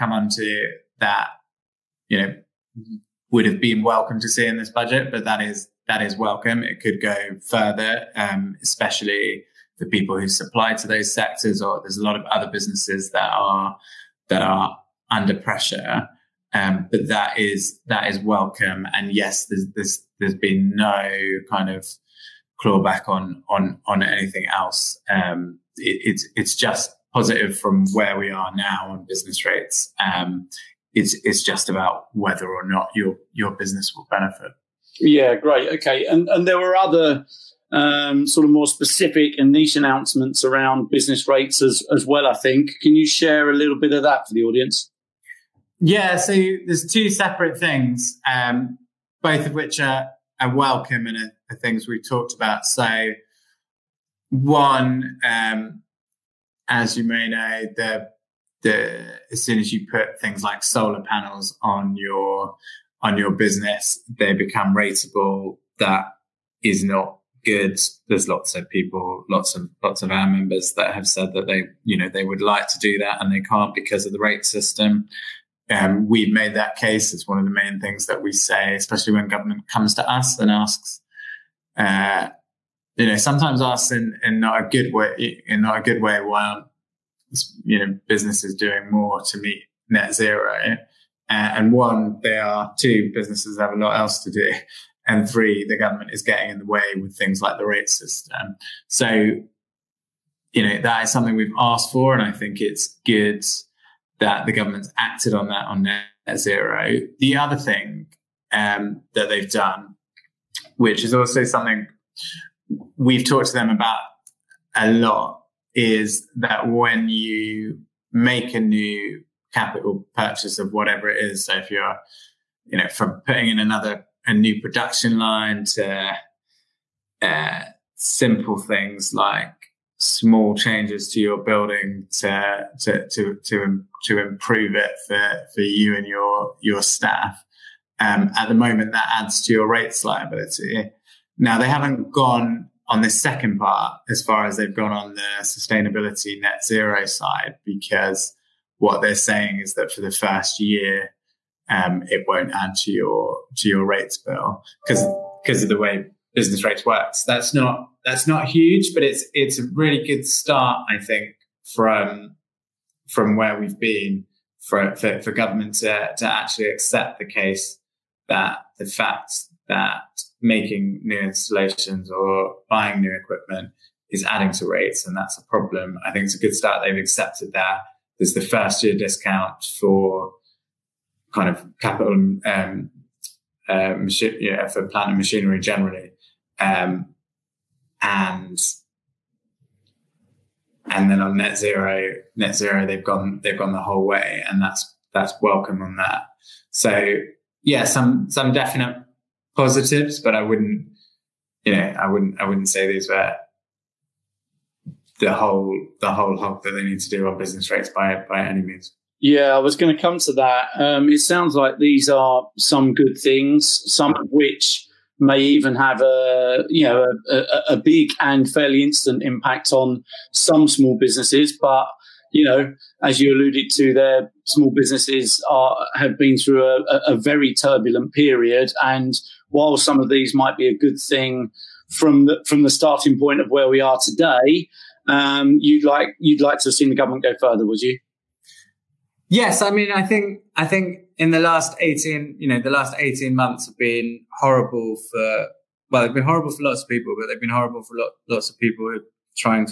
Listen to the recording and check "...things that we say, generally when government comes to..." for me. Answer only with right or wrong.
wrong.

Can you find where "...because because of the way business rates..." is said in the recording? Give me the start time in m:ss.
2:34.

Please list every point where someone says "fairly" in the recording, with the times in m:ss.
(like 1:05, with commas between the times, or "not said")
3:38.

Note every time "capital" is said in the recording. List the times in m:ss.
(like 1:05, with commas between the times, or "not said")
1:59, 3:01.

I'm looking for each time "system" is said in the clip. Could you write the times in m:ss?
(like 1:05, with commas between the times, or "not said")
1:14, 1:37.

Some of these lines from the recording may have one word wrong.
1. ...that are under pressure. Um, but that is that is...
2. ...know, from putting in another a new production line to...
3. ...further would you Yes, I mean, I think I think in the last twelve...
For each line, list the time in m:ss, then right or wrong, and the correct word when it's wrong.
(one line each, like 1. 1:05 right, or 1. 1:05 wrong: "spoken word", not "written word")
1. 0:14 right
2. 2:02 right
3. 3:57 wrong: "eighteen", not "twelve".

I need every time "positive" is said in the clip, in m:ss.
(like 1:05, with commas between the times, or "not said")
0:27, 3:19.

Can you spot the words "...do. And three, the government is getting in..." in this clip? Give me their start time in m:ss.
1:34.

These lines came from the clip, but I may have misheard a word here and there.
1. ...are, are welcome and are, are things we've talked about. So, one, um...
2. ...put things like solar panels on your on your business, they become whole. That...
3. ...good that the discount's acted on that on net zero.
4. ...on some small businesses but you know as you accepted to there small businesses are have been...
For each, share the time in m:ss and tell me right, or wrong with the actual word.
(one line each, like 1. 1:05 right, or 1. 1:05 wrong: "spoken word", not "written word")
1. 0:49 right
2. 0:59 wrong: "rateable", not "whole"
3. 1:43 wrong: "government", not "discount"
4. 3:39 wrong: "alluded", not "accepted".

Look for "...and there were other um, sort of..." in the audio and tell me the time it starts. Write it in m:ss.
0:36.